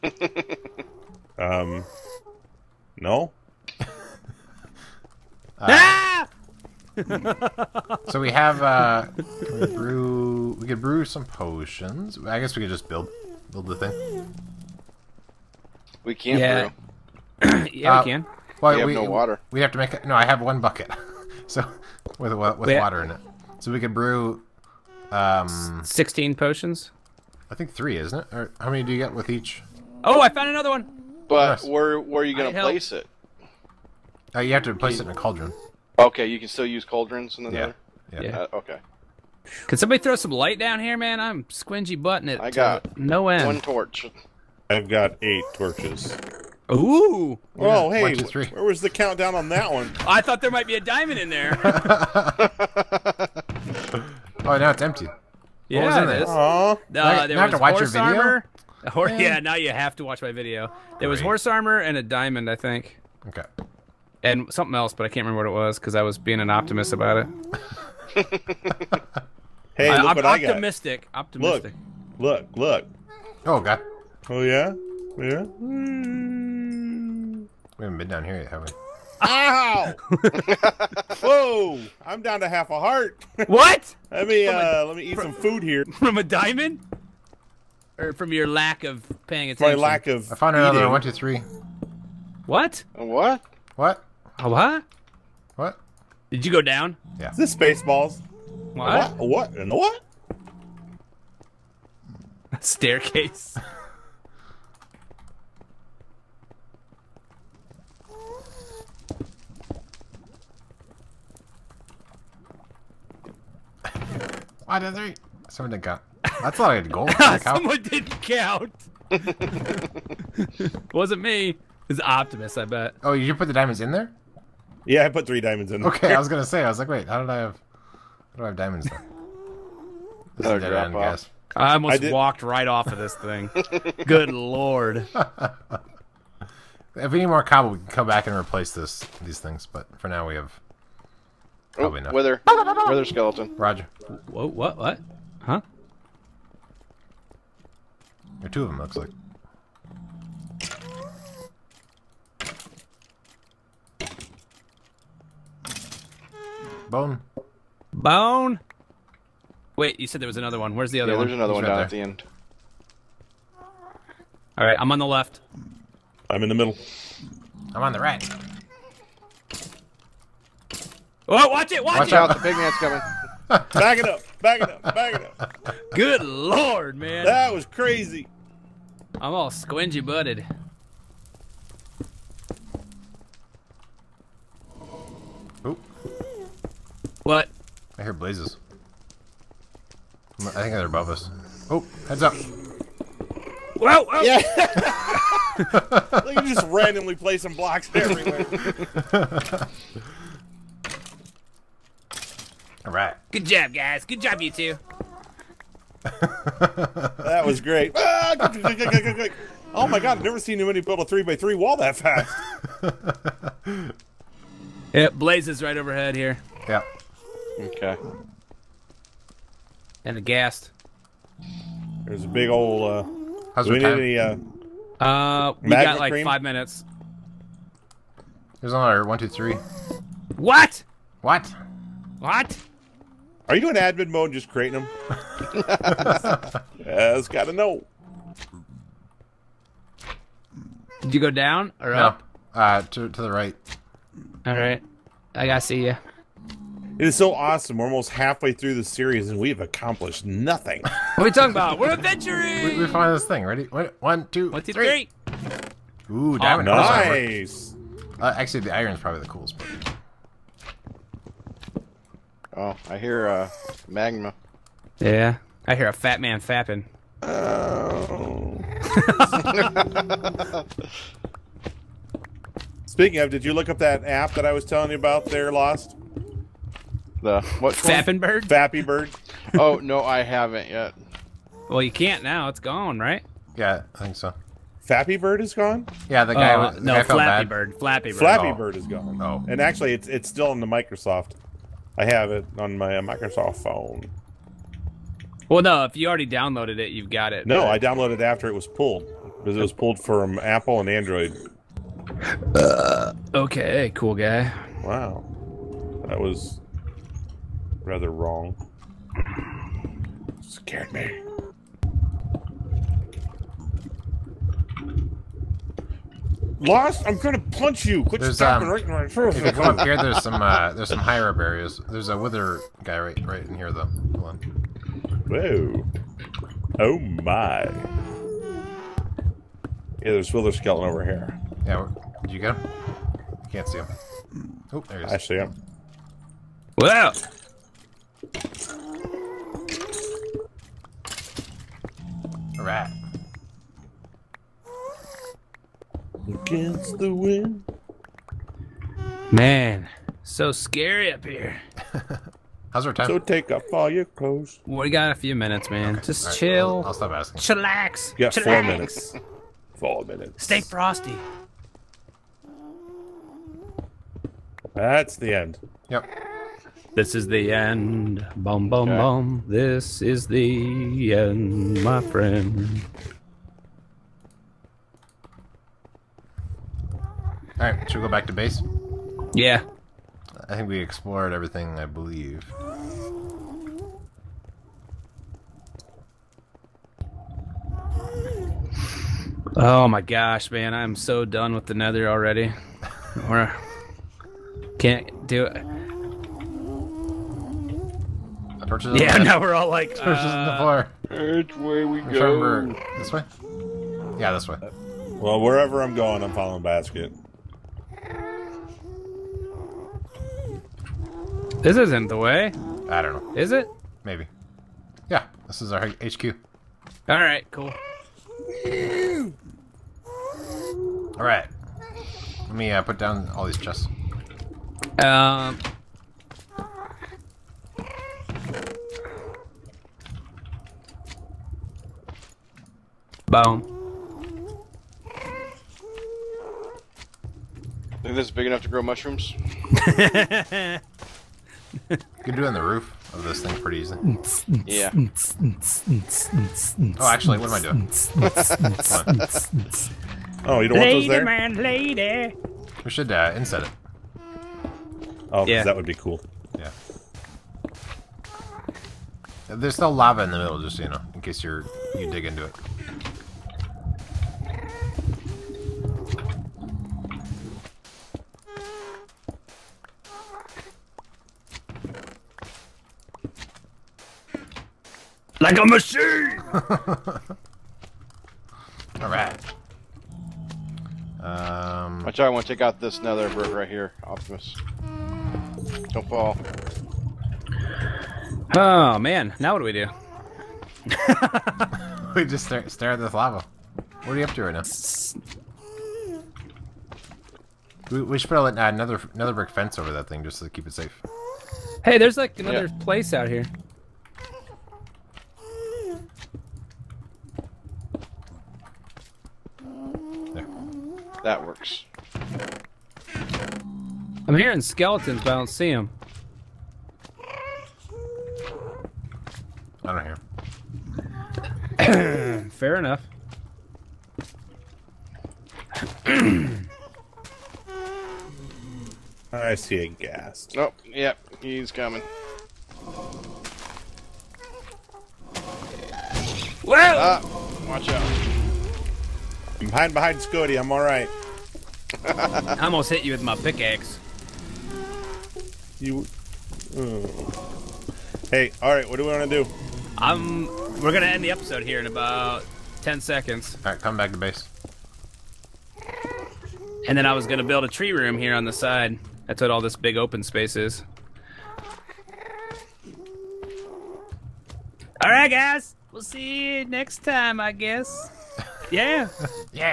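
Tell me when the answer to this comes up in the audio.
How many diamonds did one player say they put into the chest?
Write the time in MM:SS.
02:05.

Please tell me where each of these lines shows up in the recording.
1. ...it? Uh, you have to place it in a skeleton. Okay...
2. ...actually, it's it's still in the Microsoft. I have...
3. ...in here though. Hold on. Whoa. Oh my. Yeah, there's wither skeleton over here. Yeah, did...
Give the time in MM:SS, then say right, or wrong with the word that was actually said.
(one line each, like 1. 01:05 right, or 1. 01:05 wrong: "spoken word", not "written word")
1. 00:32 wrong: "cauldron", not "skeleton"
2. 04:49 right
3. 05:23 right.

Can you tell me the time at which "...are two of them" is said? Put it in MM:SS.
02:28.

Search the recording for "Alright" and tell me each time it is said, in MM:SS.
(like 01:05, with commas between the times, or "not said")
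07:59.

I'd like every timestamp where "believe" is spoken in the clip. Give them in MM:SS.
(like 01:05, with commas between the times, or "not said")
06:21.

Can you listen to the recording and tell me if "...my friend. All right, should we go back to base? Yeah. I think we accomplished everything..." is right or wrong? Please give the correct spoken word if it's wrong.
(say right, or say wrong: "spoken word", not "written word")
wrong: "explored", not "accomplished".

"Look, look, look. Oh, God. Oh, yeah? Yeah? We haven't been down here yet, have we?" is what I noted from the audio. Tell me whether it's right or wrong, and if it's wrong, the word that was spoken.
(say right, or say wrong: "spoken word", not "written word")
right.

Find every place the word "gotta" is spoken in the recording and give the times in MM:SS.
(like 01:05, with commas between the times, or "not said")
03:57, 04:05.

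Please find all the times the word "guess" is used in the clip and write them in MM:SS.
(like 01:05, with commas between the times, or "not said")
00:12, 09:27.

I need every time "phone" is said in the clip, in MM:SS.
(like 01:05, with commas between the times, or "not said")
04:53.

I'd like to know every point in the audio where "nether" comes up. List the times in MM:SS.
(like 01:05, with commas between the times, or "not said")
06:31, 08:03.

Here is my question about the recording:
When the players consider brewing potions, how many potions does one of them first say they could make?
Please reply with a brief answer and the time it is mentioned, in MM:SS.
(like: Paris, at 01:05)
16, at 00:25.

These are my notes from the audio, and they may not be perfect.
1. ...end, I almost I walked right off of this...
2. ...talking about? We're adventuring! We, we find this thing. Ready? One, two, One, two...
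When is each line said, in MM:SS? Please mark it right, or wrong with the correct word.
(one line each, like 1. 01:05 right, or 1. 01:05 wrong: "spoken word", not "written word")
1. 02:10 right
2. 04:11 right.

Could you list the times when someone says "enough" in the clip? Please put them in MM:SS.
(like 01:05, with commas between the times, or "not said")
02:22, 07:18, 08:42.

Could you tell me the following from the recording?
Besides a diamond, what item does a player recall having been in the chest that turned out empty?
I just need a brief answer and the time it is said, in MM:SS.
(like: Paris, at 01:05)
horse armor, at 01:01.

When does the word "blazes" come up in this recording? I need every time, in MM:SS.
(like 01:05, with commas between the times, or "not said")
03:08, 03:35.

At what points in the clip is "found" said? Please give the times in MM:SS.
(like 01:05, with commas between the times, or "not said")
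00:30, 01:30.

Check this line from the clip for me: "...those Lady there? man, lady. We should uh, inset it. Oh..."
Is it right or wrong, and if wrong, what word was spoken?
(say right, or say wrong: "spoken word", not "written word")
right.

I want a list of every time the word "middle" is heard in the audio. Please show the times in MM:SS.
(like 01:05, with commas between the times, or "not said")
02:46, 07:40.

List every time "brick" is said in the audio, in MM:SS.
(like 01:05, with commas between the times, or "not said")
08:03, 08:19.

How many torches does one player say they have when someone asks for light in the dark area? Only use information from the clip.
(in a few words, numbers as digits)
8.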